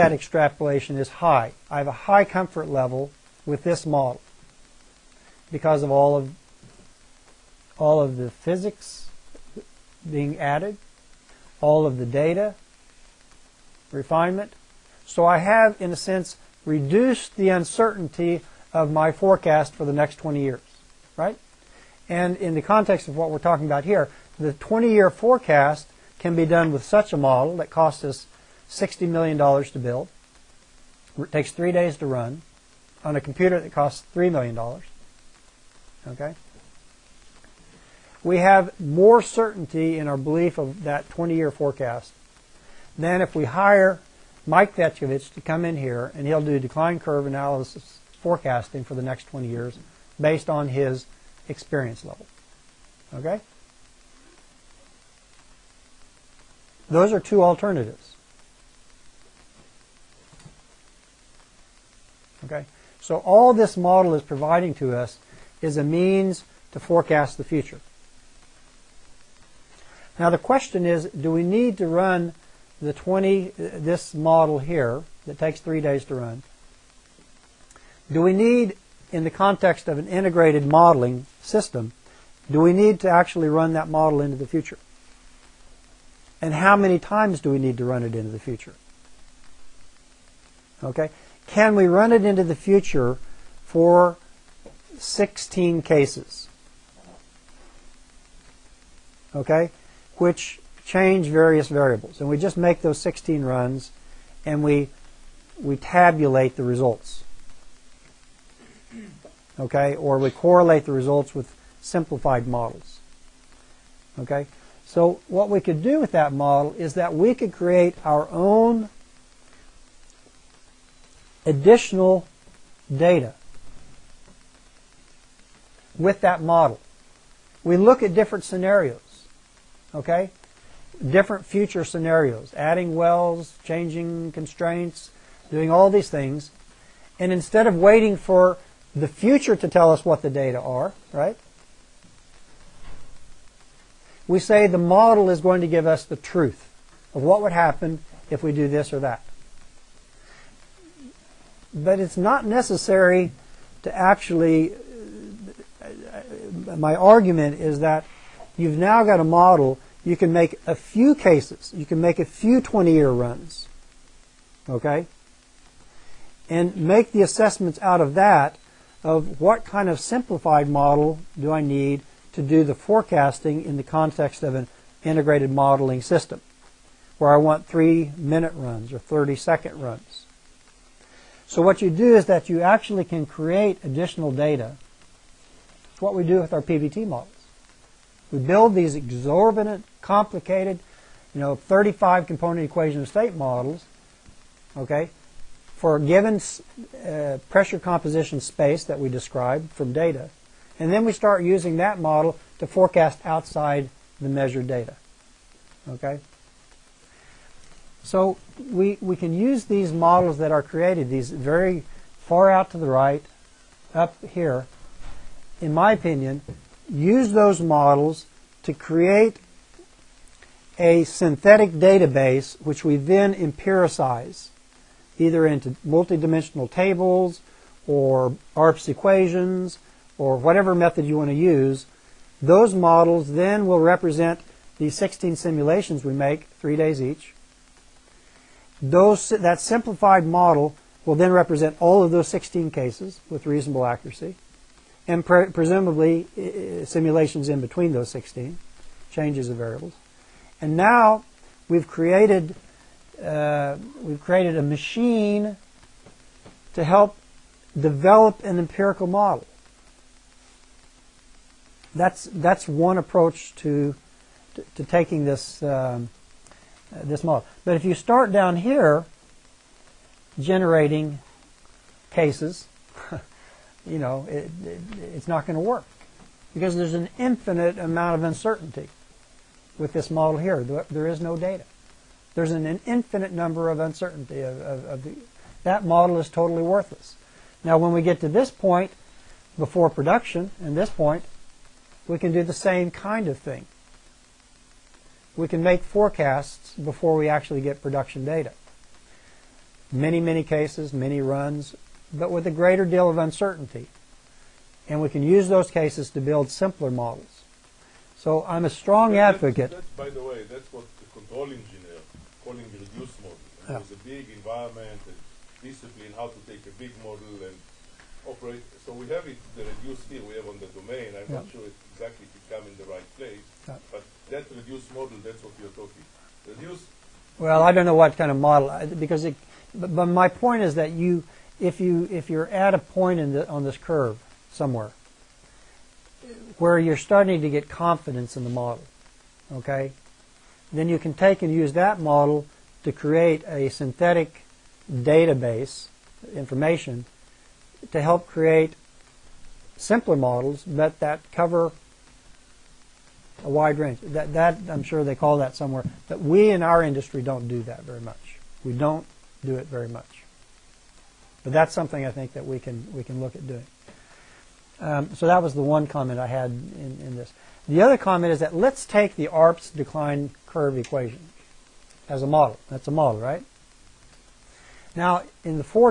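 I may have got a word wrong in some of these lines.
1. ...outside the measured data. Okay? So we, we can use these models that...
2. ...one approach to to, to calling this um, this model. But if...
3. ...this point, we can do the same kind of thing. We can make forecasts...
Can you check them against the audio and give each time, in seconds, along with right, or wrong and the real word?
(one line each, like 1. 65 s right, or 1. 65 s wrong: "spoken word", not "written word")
1. 203 s right
2. 262 s wrong: "taking", not "calling"
3. 290 s right.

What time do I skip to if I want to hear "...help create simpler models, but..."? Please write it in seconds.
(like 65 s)
347 s.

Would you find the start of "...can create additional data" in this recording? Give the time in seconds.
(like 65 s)
183 s.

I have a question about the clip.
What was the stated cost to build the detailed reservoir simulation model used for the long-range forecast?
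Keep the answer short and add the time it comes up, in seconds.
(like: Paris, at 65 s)
$60 million, at 28 s.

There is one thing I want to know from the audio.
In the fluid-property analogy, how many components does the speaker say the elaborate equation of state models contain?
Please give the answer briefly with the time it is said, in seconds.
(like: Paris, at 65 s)
35, at 191 s.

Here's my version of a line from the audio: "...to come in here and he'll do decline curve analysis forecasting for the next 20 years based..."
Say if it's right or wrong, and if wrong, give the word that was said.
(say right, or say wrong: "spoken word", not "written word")
right.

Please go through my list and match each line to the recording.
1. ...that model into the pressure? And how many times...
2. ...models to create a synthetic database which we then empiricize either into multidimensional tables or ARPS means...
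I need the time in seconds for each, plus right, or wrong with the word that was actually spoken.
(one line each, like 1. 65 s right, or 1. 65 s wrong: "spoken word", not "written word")
1. 83 s wrong: "future", not "pressure"
2. 217 s wrong: "equations", not "means".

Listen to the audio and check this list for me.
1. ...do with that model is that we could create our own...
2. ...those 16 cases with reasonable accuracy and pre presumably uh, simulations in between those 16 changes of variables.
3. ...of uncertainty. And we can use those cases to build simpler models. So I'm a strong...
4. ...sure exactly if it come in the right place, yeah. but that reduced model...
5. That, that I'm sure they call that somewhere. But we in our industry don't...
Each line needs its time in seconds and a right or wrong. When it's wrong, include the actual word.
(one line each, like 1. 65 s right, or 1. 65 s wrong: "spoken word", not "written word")
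1. 115 s right
2. 242 s right
3. 303 s right
4. 321 s right
5. 353 s right.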